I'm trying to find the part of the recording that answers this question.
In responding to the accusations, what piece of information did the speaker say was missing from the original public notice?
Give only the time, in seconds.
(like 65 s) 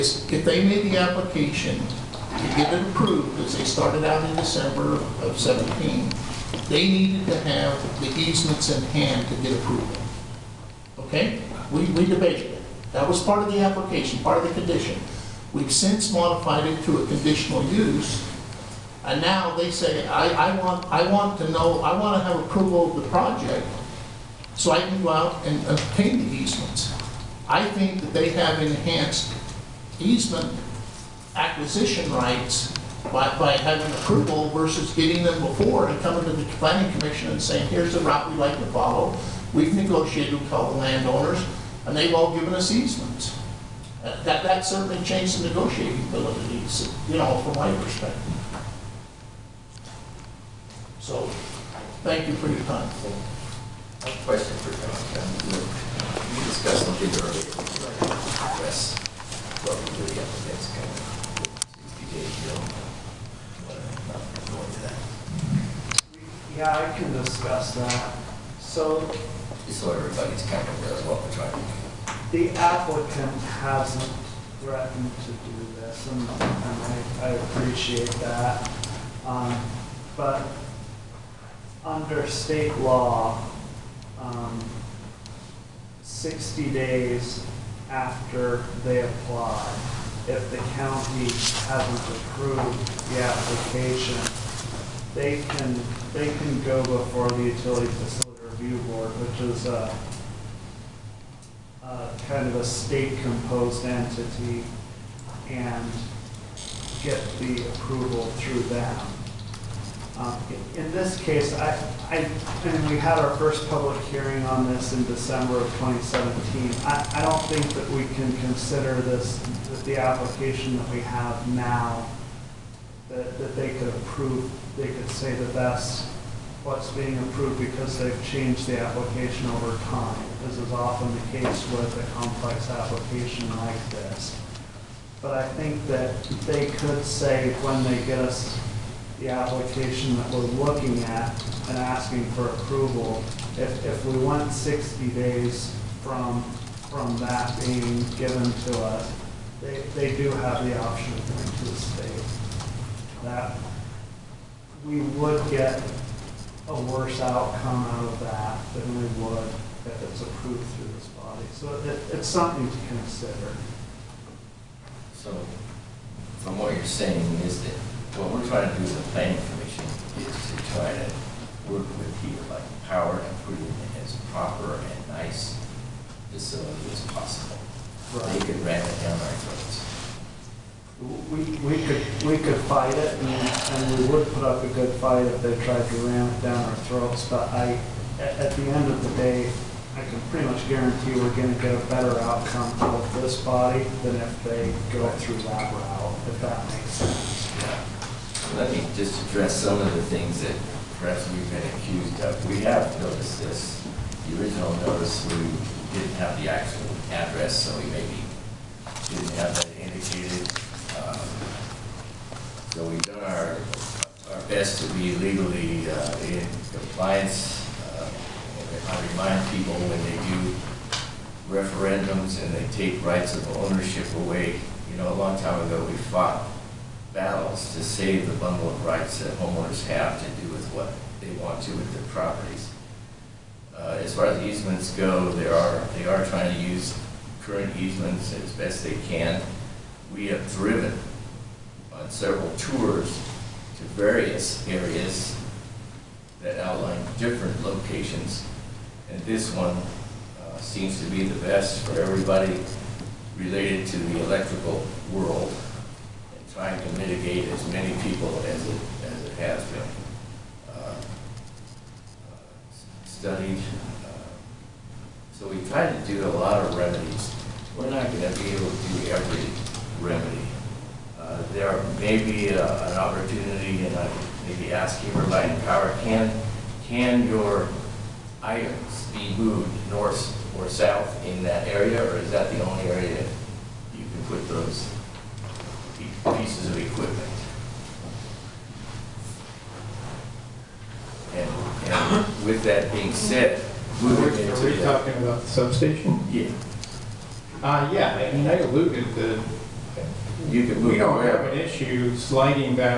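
206 s.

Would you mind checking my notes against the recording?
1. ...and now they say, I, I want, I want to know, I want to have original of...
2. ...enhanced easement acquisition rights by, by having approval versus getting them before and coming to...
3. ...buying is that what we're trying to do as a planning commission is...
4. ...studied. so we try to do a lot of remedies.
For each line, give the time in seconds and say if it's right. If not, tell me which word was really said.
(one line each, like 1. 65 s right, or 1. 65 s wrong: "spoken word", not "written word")
1. 19 s wrong: "approval", not "original"
2. 28 s right
3. 166 s wrong: "saying", not "buying"
4. 263 s right.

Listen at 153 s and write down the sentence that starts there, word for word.
That we would get a worse outcome out of that than we would if it's approved through this body.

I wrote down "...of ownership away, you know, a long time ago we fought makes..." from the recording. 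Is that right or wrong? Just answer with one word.
wrong.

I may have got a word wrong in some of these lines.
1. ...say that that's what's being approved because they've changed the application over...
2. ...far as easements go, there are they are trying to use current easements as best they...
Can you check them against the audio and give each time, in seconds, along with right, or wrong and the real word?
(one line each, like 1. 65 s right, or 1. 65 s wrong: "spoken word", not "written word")
1. 125 s right
2. 234 s right.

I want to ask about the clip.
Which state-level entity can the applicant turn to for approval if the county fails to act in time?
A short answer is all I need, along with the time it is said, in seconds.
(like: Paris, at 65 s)
Utility facility review board, at 97 s.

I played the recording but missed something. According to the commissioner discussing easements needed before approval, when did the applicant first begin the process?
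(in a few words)
December 2017.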